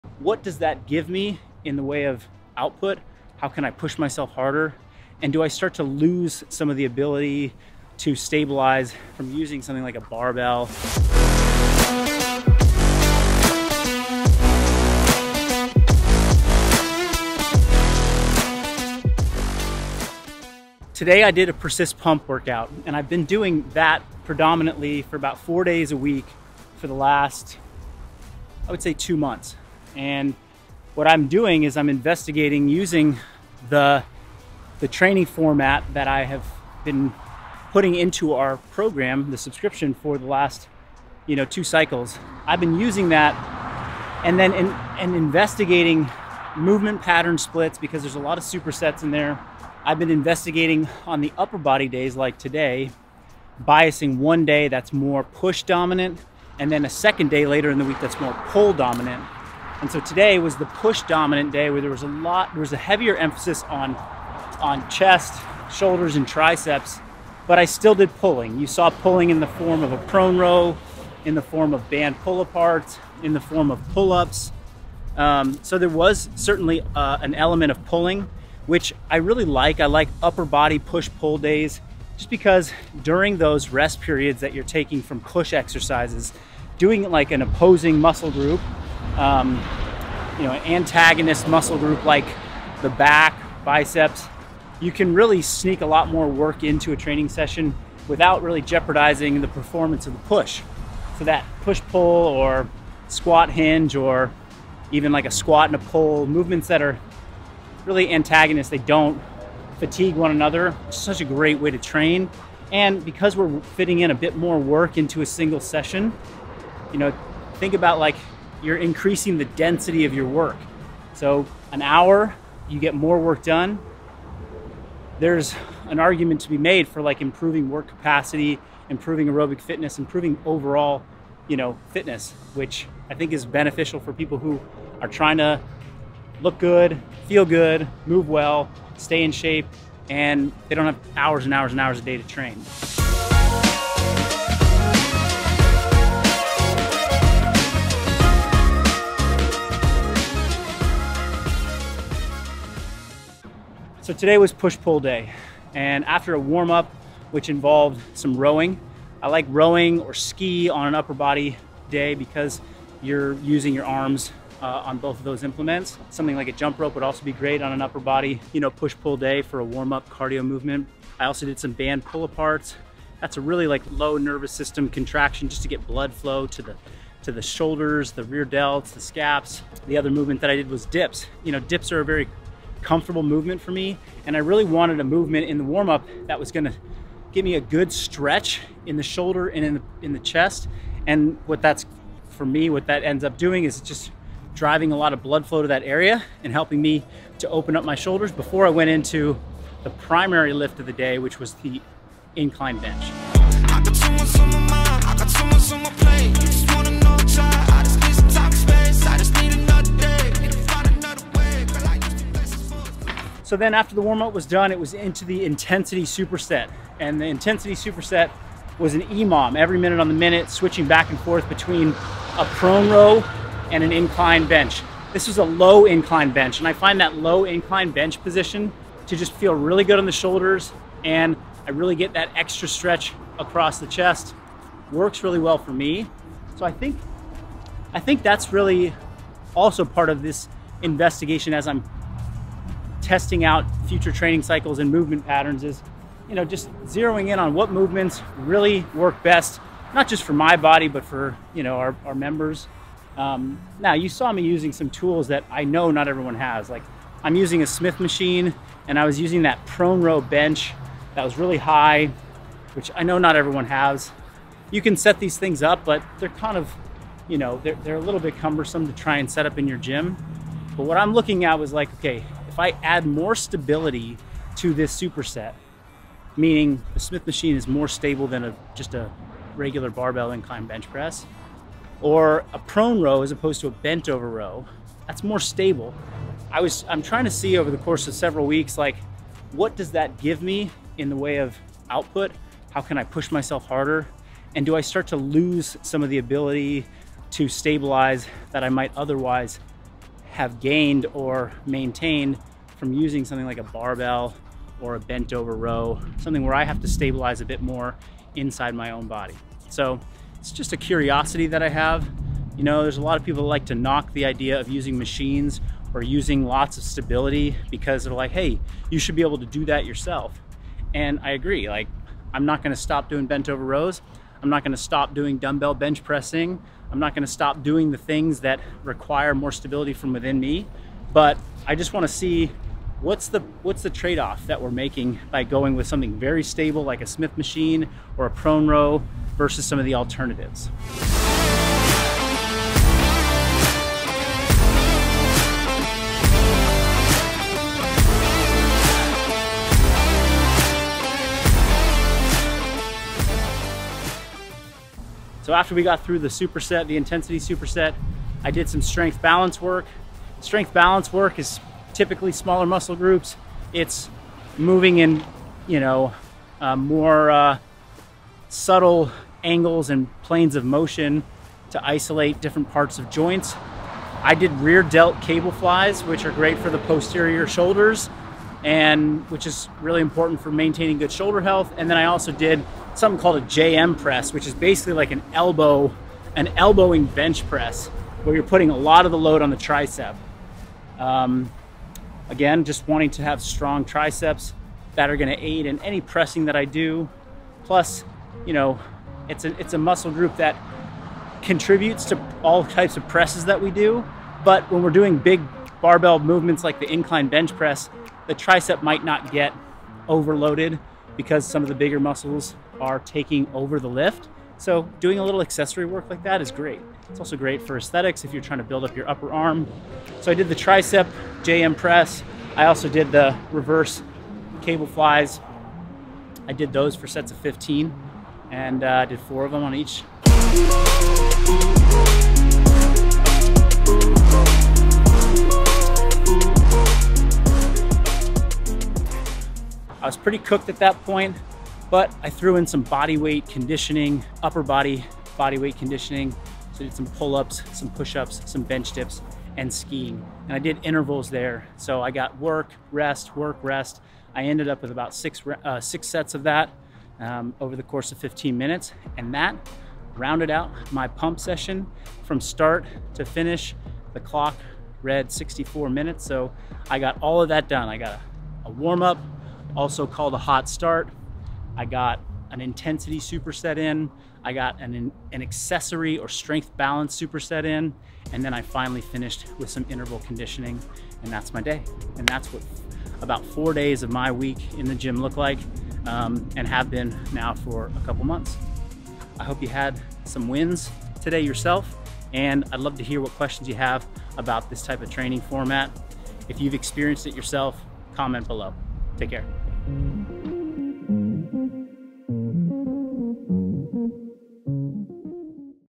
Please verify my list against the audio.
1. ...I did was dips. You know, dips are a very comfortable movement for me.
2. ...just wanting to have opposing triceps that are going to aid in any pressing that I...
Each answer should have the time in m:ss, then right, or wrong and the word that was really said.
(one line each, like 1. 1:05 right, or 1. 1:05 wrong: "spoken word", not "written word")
1. 3:00 right
2. 6:32 wrong: "strong", not "opposing".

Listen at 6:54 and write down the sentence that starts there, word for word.
So doing a little accessory work like that is great.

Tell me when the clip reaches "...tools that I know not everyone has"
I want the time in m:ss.
4:14.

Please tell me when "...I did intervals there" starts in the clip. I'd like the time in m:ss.
7:30.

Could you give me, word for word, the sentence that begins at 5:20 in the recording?
And I agree, like I'm not gonna stop doing bent over rows.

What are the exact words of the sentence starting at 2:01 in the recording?
So an hour, you get more work done.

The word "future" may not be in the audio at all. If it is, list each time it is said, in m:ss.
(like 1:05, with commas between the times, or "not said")
4:03.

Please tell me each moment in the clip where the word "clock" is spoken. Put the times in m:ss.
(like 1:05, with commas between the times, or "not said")
7:44.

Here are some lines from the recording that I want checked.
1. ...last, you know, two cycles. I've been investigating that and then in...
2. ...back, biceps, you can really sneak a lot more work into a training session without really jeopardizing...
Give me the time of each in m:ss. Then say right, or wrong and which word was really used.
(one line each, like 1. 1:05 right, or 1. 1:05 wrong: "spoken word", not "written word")
1. 0:40 wrong: "using", not "investigating"
2. 1:32 right.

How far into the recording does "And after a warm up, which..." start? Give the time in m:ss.
2:35.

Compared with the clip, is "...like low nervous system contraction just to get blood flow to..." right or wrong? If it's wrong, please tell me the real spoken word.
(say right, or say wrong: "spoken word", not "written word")
right.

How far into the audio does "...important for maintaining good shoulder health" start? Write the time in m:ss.
6:20.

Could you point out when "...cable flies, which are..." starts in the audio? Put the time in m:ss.
6:15.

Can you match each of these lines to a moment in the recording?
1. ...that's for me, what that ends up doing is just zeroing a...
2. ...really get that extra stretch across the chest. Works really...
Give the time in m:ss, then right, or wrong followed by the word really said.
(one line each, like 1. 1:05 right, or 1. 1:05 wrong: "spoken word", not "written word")
1. 3:11 wrong: "driving", not "zeroing"
2. 3:51 right.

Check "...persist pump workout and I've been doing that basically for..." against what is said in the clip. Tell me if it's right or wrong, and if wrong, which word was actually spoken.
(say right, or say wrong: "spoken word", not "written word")
wrong: "predominantly", not "basically".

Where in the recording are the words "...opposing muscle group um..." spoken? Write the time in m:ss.
1:27.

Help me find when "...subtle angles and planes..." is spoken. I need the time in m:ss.
6:08.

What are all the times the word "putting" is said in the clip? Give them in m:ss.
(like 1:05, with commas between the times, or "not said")
0:37, 6:28.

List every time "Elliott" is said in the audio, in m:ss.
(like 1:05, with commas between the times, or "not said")
not said.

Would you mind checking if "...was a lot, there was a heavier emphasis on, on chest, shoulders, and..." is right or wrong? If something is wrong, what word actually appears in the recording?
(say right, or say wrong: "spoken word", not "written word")
right.